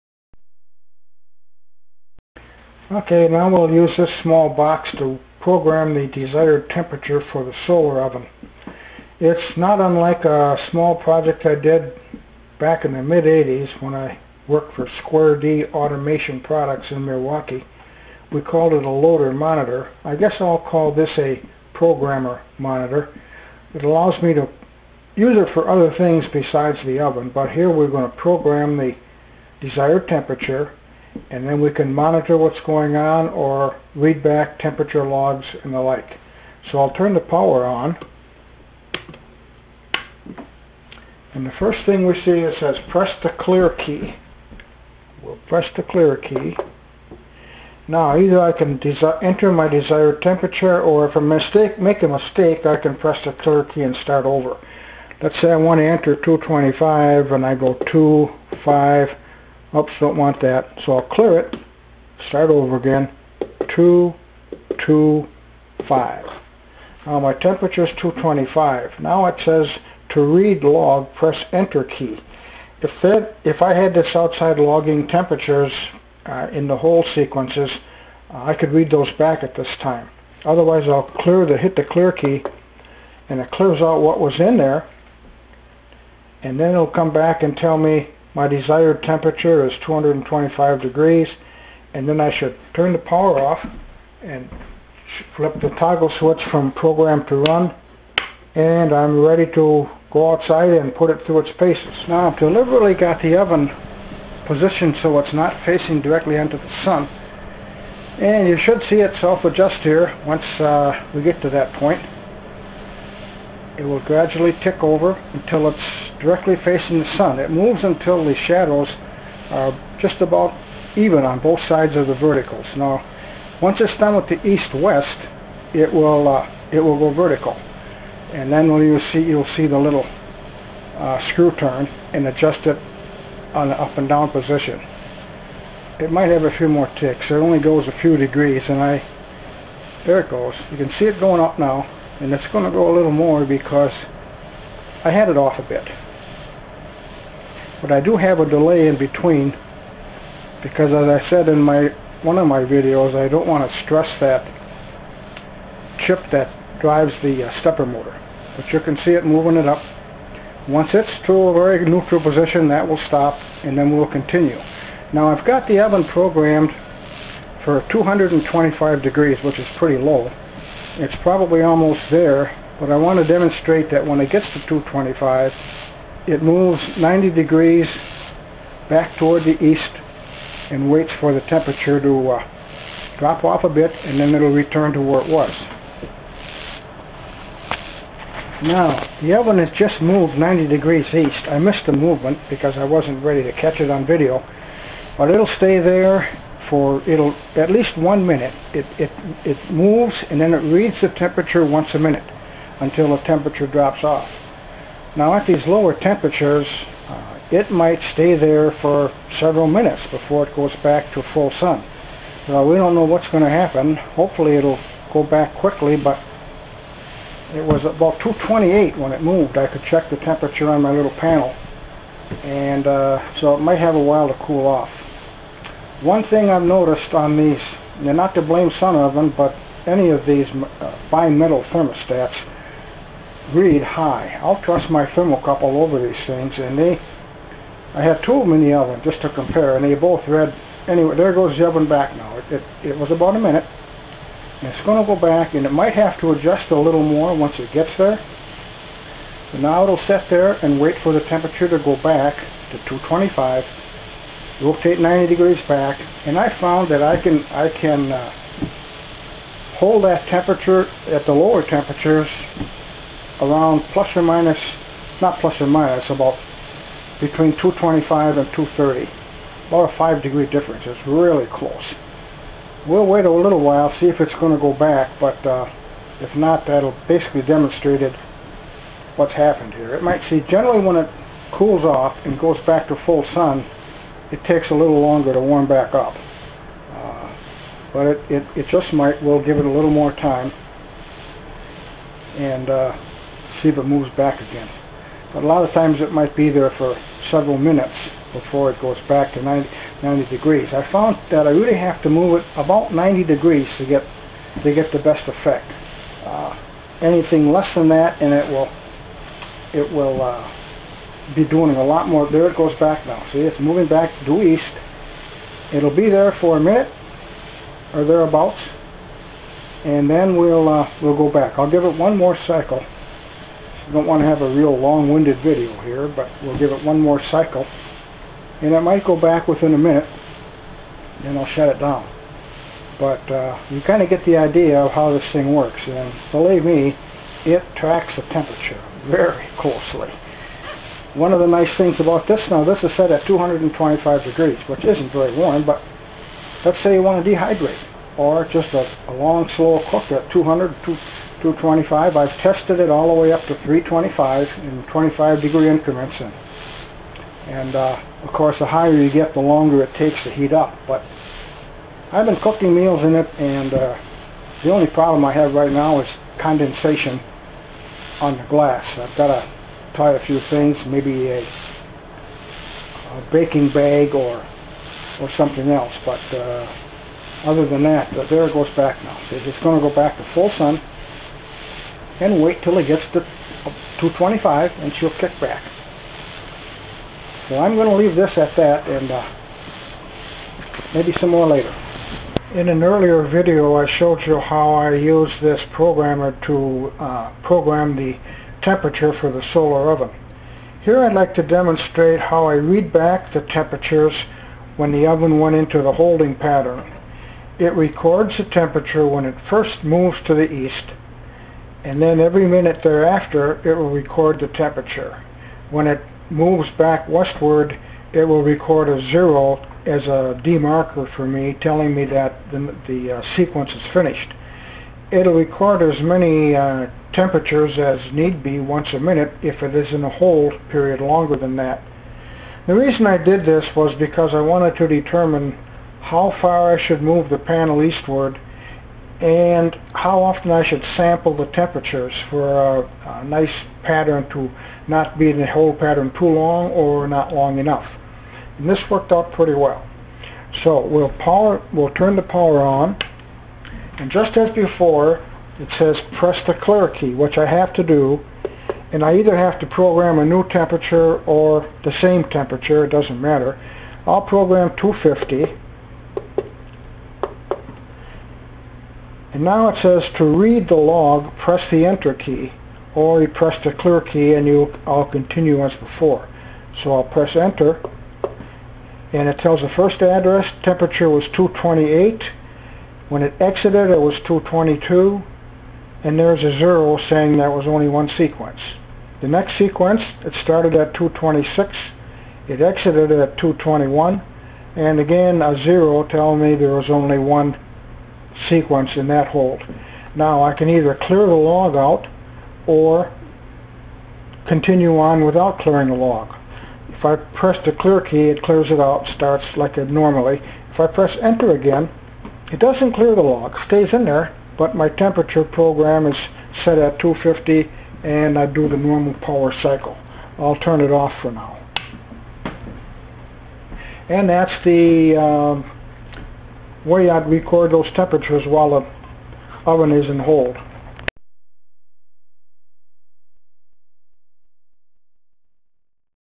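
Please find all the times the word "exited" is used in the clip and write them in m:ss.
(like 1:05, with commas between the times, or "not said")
8:03, 8:12.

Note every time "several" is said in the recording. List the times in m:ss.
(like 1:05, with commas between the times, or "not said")
3:29, 4:57.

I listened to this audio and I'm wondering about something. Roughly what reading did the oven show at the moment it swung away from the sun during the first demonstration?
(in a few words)
228.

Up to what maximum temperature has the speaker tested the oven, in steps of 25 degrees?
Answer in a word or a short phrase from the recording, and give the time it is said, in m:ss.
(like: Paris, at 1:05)
325, at 5:53.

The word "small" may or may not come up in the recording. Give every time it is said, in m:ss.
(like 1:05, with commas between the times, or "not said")
0:04, 0:10.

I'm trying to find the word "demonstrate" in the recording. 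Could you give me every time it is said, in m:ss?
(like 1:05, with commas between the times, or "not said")
2:53, 4:37, 6:41.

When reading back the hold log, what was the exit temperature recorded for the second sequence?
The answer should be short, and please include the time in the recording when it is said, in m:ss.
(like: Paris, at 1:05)
221, at 8:13.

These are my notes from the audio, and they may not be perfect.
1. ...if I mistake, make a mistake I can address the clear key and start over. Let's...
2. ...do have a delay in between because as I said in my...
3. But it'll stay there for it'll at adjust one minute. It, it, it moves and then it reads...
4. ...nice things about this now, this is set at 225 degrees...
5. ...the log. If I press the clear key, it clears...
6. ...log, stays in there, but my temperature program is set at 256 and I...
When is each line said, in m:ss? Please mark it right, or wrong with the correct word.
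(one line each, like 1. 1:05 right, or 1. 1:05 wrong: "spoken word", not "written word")
1. 0:51 wrong: "press", not "address"
2. 2:27 right
3. 3:15 wrong: "least", not "adjust"
4. 5:41 right
5. 8:25 right
6. 8:33 wrong: "250", not "256".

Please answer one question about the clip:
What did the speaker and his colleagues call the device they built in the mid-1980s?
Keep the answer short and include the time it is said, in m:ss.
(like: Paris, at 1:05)
loader monitor, at 0:18.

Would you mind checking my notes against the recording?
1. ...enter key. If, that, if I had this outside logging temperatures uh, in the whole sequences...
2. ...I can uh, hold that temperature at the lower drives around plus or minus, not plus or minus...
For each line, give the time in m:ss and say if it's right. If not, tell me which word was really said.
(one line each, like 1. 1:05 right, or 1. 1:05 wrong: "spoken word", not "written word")
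1. 1:11 right
2. 4:17 wrong: "temperatures", not "drives".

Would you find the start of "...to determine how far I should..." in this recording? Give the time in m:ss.
7:14.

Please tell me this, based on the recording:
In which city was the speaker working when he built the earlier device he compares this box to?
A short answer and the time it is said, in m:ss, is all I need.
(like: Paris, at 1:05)
Milwaukee, at 0:17.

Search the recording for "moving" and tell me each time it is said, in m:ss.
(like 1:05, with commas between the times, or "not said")
2:39, 5:13.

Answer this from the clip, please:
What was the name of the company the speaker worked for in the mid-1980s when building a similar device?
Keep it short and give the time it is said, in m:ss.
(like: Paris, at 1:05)
Square D Automation Products, at 0:15.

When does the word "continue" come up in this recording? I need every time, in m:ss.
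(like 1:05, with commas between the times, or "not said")
2:44, 7:55, 8:24.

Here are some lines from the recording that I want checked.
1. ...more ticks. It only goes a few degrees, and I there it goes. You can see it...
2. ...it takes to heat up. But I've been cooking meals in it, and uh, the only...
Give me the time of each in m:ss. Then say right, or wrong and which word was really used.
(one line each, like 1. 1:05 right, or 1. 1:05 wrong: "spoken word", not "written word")
1. 2:16 right
2. 5:59 right.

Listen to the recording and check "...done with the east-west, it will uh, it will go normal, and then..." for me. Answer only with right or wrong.
wrong.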